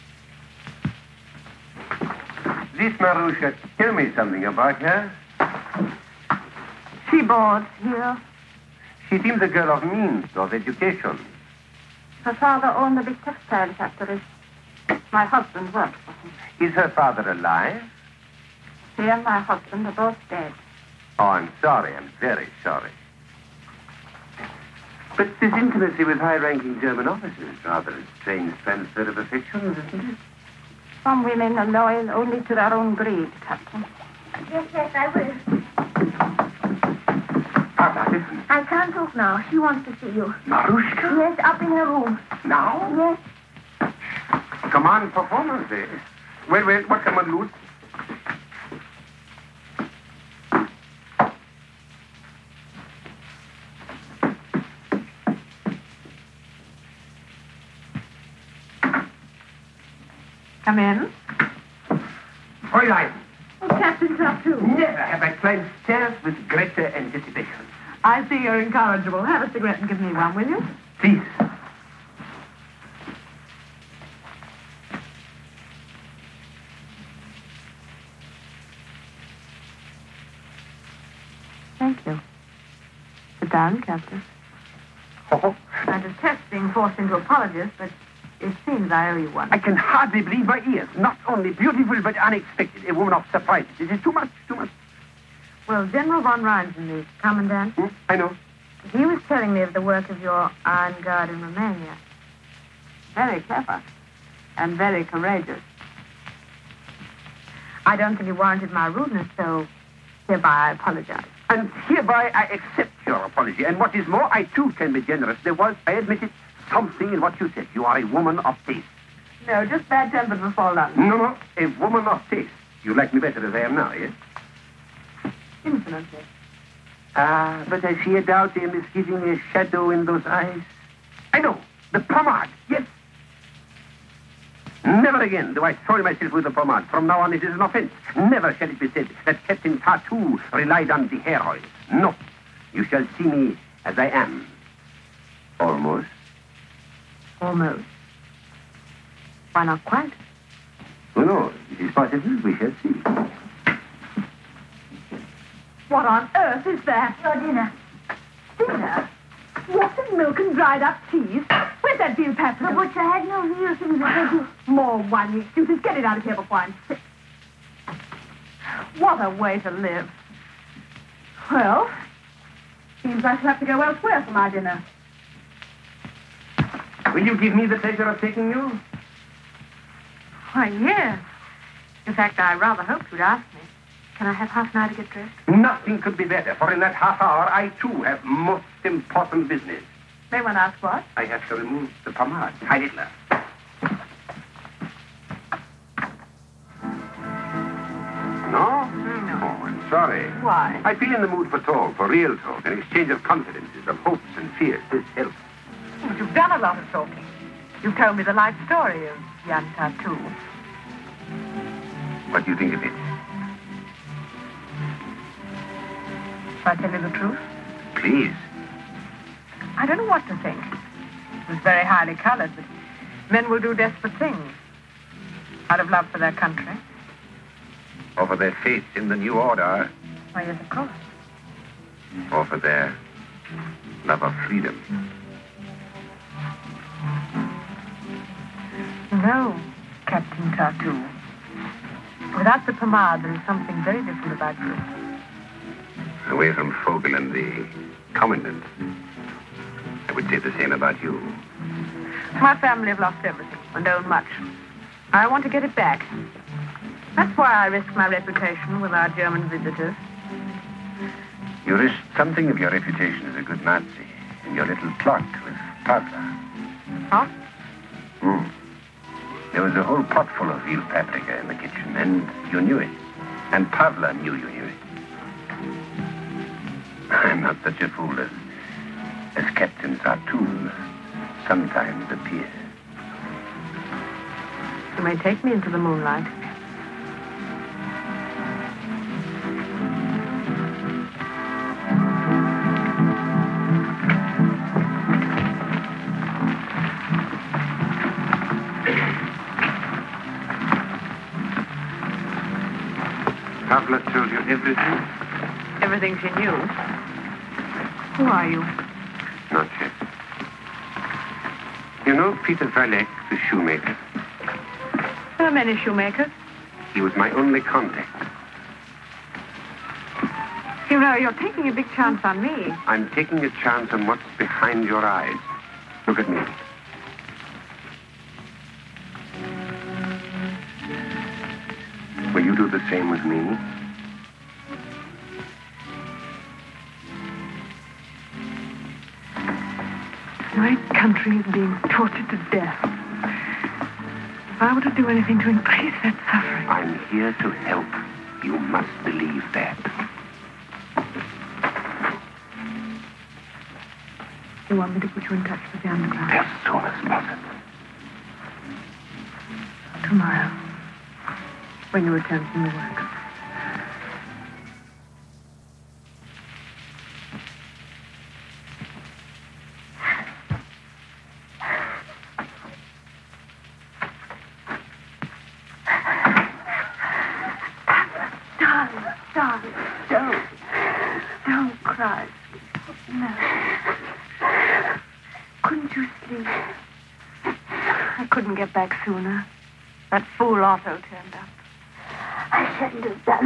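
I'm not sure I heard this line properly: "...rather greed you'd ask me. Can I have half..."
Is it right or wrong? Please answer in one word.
wrong.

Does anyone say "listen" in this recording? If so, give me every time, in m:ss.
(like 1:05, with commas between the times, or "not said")
0:38.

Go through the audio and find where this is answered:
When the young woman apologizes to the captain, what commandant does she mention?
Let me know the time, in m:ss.
1:35.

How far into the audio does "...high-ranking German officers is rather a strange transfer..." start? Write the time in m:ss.
0:26.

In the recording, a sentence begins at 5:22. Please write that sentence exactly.
I'm taking a chance on what's behind your eyes.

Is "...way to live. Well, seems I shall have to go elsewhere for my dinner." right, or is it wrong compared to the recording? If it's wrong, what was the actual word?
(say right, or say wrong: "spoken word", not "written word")
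right.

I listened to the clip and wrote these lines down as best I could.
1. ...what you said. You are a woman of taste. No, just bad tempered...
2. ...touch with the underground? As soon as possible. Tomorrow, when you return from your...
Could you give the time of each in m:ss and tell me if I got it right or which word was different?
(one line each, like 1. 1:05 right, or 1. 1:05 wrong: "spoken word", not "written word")
1. 1:57 right
2. 5:55 right.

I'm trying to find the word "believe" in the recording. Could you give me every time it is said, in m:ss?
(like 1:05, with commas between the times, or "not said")
1:30, 5:49.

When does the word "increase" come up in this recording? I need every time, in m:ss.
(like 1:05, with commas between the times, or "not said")
5:45.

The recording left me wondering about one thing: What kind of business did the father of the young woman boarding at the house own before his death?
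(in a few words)
textile factory.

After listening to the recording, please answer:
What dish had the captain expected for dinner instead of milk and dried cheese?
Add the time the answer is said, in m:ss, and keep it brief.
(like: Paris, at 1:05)
veal paprika, at 2:42.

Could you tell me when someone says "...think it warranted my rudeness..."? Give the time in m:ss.
1:48.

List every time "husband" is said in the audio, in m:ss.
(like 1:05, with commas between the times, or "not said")
0:15, 0:19.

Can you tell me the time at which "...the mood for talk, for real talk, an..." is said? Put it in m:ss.
3:21.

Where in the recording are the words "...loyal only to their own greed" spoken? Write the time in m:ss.
0:31.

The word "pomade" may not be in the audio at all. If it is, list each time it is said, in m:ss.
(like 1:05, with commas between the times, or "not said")
2:12, 2:16, 3:12, 4:02.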